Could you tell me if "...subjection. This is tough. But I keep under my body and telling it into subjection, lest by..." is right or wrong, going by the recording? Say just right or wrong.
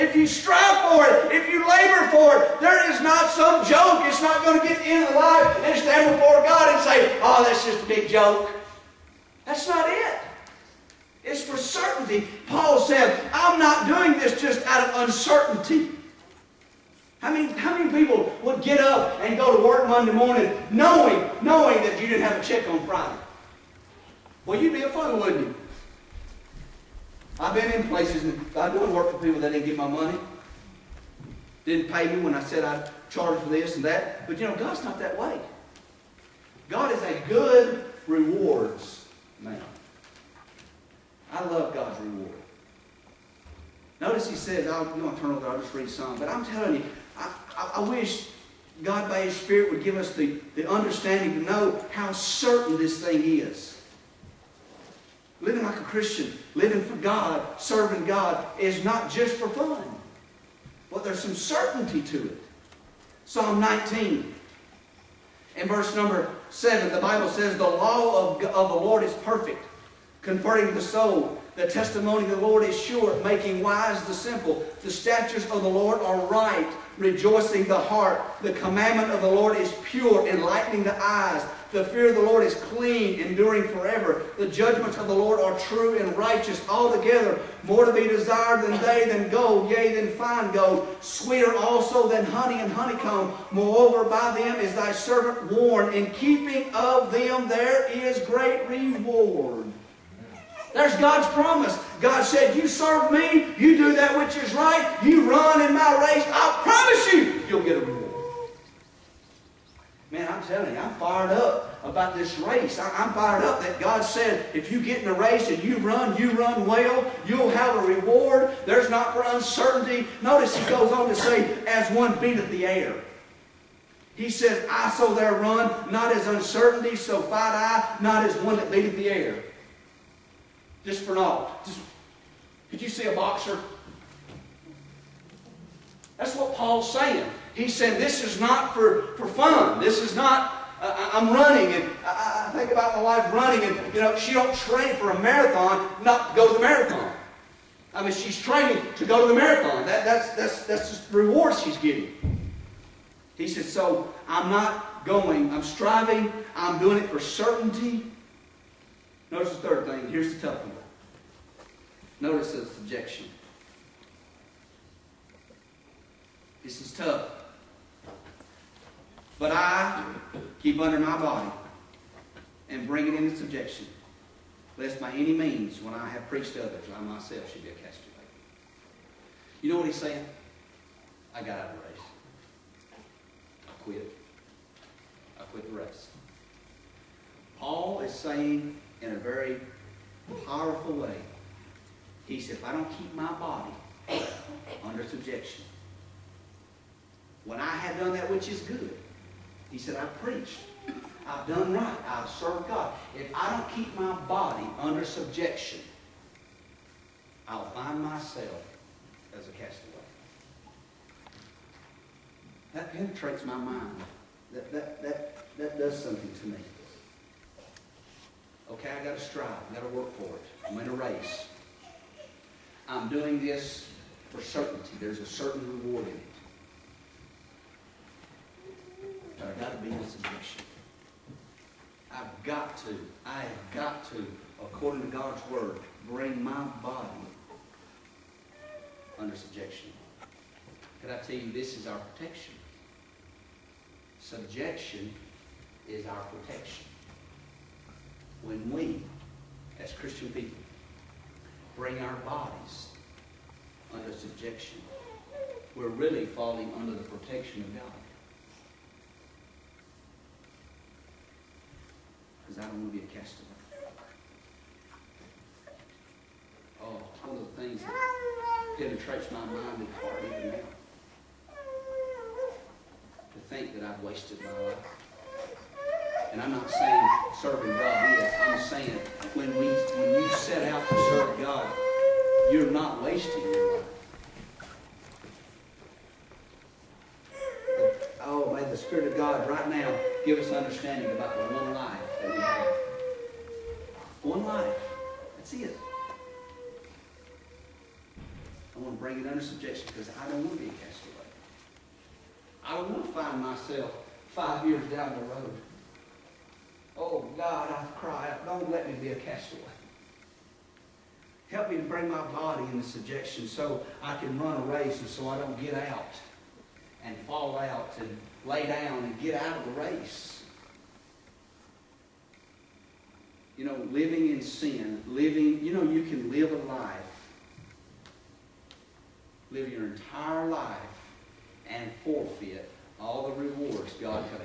wrong.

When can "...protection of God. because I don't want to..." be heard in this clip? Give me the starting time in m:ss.
4:17.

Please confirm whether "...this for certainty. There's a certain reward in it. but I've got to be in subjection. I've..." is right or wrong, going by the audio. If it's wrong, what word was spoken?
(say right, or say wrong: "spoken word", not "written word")
right.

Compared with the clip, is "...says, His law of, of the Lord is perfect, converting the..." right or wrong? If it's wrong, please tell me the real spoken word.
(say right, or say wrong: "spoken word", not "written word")
wrong: "The", not "His".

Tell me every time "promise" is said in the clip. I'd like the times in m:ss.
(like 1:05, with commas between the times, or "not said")
1:41, 1:46.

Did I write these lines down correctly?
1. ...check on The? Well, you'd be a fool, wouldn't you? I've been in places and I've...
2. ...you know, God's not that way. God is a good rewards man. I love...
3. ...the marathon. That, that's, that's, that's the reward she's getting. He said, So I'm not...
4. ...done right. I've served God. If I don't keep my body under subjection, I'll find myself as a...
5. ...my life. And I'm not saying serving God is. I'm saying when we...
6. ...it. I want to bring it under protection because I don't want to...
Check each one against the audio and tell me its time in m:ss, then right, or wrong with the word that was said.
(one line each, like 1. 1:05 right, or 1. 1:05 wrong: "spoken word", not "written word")
1. 0:22 wrong: "Friday", not "The"
2. 0:34 right
3. 2:29 right
4. 3:21 right
5. 4:34 right
6. 4:55 wrong: "subjection", not "protection".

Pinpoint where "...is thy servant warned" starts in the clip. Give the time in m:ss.
1:34.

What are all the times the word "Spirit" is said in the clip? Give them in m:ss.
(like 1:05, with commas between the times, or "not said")
0:49, 4:48.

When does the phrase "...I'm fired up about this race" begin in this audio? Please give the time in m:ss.
1:50.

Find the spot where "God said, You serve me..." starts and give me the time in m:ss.
1:42.